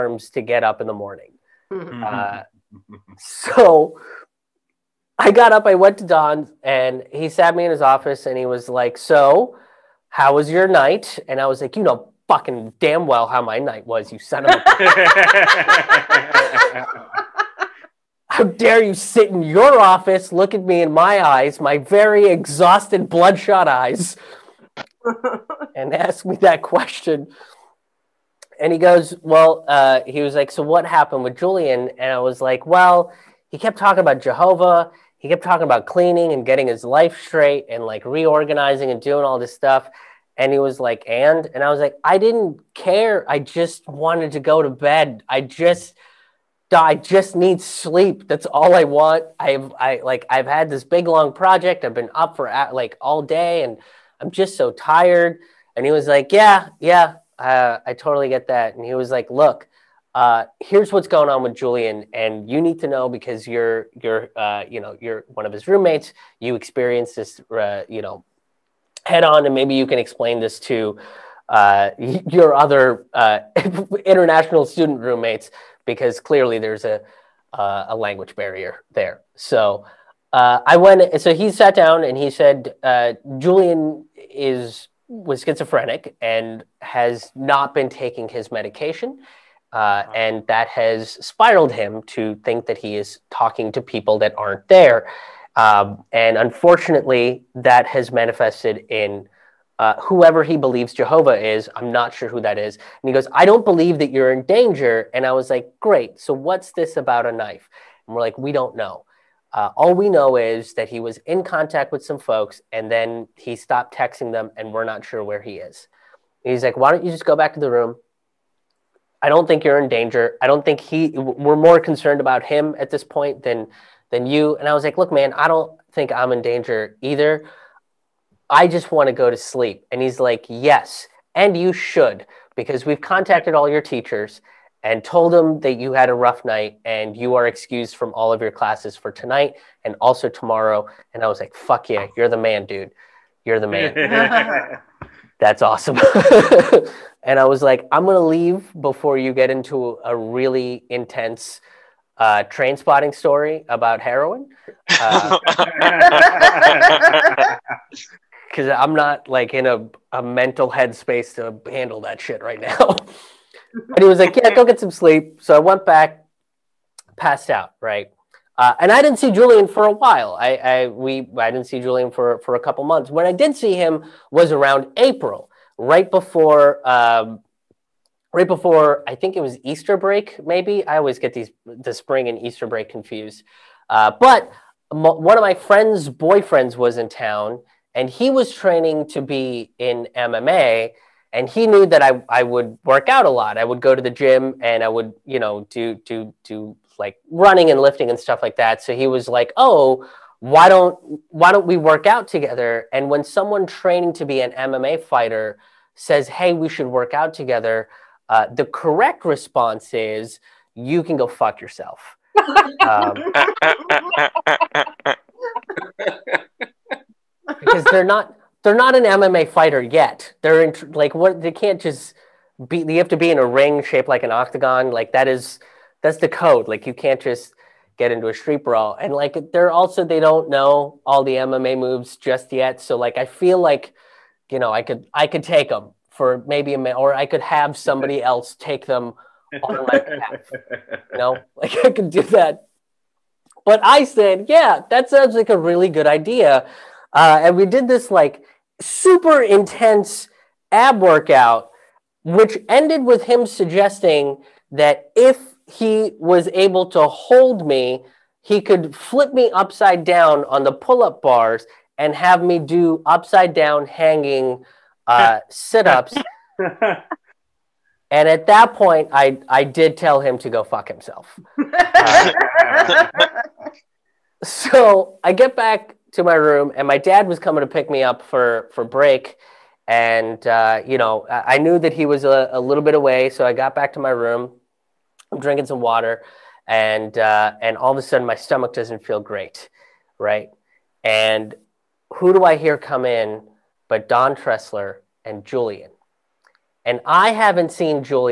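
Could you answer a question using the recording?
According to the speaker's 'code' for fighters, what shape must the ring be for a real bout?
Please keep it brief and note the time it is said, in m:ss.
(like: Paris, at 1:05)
Octagon, at 3:44.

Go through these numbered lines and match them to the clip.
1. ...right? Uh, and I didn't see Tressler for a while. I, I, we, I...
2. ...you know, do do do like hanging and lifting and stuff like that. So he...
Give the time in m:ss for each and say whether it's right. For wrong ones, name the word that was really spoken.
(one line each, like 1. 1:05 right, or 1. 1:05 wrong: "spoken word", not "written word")
1. 2:47 wrong: "Julian", not "Tressler"
2. 3:15 wrong: "running", not "hanging".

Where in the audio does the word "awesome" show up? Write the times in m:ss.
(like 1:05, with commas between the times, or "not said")
2:25.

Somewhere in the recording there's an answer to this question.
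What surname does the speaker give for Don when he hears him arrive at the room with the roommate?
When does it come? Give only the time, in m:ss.
4:54.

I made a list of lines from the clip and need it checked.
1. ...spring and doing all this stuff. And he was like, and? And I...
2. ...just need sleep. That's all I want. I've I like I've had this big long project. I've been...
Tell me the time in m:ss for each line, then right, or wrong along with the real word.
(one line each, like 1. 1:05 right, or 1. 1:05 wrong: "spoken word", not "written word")
1. 0:38 wrong: "reorganizing", not "spring"
2. 0:46 right.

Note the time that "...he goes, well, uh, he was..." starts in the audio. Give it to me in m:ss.
0:28.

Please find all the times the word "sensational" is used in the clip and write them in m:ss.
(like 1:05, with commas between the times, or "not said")
not said.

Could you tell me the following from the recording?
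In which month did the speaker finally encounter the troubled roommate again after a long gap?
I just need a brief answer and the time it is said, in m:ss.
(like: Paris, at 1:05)
April, at 2:54.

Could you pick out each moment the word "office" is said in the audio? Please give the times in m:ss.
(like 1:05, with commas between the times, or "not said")
0:07, 0:19.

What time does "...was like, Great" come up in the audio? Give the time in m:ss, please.
1:45.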